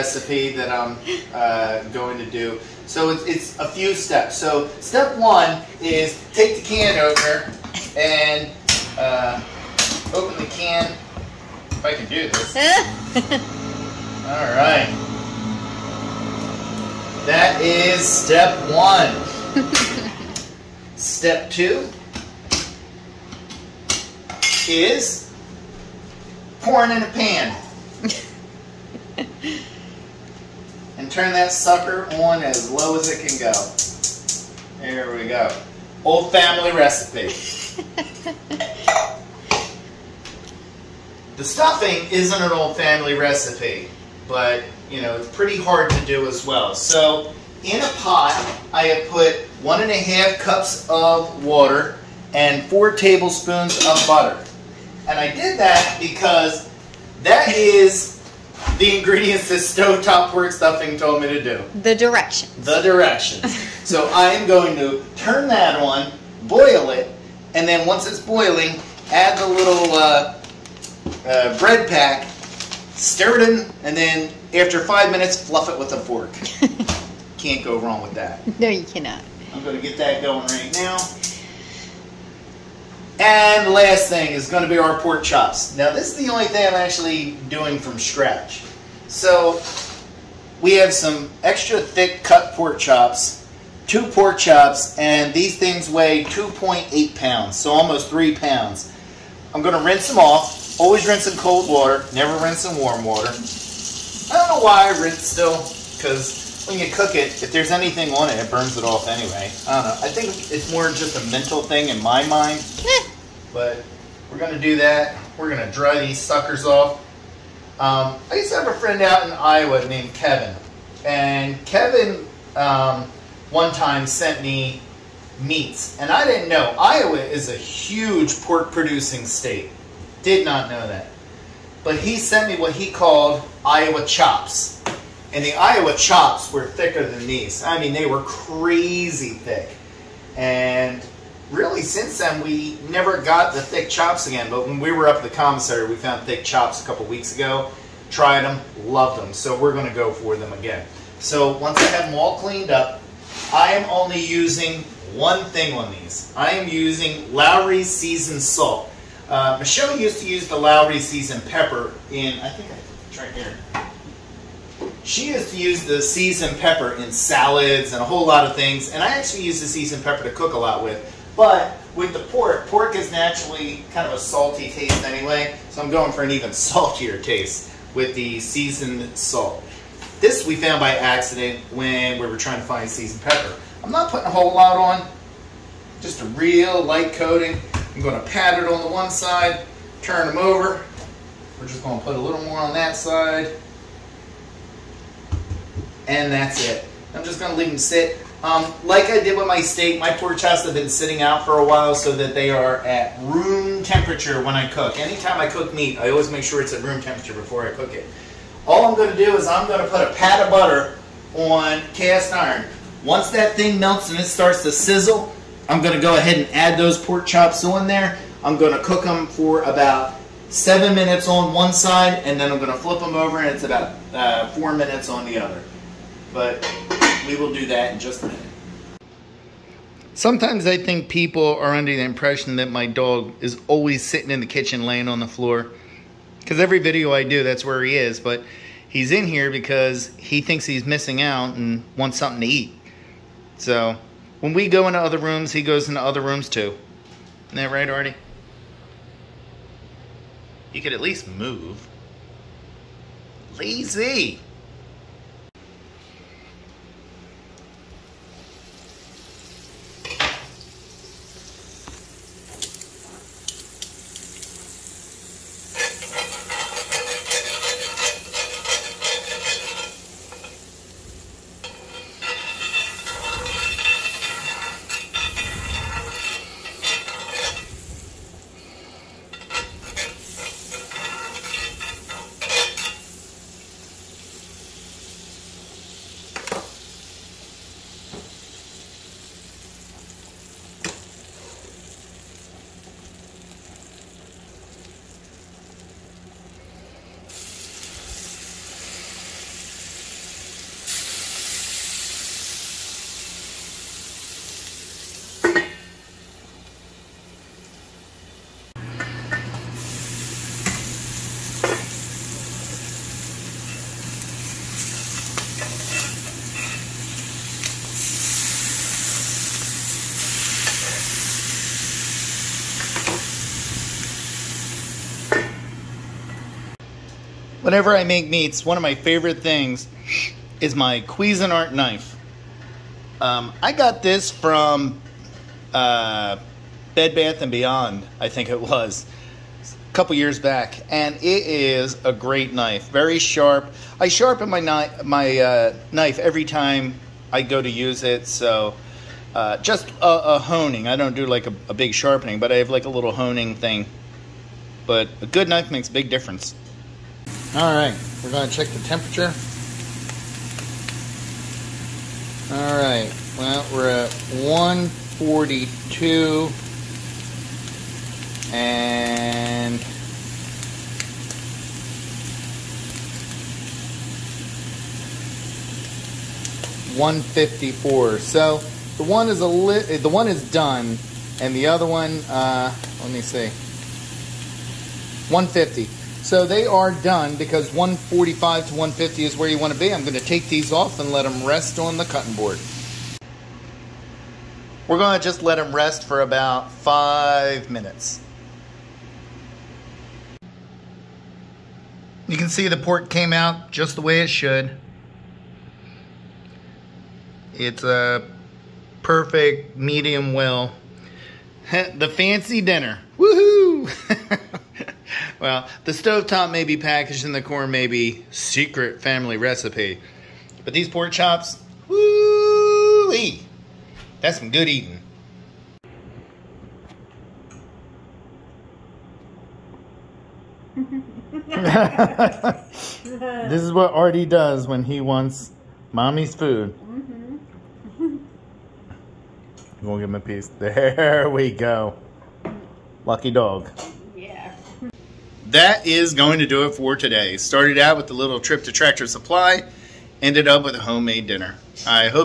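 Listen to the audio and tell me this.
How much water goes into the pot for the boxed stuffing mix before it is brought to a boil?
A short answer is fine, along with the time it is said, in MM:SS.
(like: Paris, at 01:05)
1.5 cups, at 00:49.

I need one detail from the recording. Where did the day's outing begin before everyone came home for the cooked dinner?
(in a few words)
Tractor Supply.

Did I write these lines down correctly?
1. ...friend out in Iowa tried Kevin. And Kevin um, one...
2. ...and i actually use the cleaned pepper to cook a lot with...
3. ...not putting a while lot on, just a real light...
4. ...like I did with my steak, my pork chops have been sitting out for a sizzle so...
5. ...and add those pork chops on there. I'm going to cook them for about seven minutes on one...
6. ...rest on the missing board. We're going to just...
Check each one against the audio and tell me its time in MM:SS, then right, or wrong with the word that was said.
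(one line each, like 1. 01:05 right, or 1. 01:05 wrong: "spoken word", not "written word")
1. 01:58 wrong: "named", not "tried"
2. 02:48 wrong: "seasoned", not "cleaned"
3. 03:03 wrong: "whole", not "while"
4. 03:18 wrong: "while", not "sizzle"
5. 03:36 right
6. 06:31 wrong: "cutting", not "missing".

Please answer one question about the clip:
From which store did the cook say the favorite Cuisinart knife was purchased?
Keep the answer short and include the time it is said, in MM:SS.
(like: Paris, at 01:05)
Bed Bath and Beyond, at 05:36.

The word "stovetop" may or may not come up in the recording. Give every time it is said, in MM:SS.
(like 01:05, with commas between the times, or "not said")
00:59, 06:55.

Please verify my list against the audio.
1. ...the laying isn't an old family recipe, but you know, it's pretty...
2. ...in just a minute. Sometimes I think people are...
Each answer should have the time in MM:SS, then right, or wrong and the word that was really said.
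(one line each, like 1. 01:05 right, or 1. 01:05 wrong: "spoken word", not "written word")
1. 00:41 wrong: "stuffing", not "laying"
2. 03:47 right.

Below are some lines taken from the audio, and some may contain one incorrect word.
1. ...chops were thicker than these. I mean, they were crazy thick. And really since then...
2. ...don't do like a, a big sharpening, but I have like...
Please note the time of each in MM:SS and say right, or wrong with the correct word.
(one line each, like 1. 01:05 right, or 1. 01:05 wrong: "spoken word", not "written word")
1. 02:15 right
2. 05:50 right.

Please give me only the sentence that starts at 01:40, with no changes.
Always rinse in cold water, never rinse in warm water.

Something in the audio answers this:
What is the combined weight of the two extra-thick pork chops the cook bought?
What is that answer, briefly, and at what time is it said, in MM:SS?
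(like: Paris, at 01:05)
2.8 pounds, at 01:36.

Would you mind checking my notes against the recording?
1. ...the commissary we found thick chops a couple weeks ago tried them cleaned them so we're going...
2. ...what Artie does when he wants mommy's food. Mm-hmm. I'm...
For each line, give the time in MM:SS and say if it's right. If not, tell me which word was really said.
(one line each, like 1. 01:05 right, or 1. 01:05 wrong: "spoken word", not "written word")
1. 02:25 wrong: "loved", not "cleaned"
2. 07:13 right.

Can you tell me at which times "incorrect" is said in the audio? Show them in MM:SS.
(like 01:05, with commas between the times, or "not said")
not said.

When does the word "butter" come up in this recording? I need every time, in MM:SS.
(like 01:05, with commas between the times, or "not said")
00:54, 03:30.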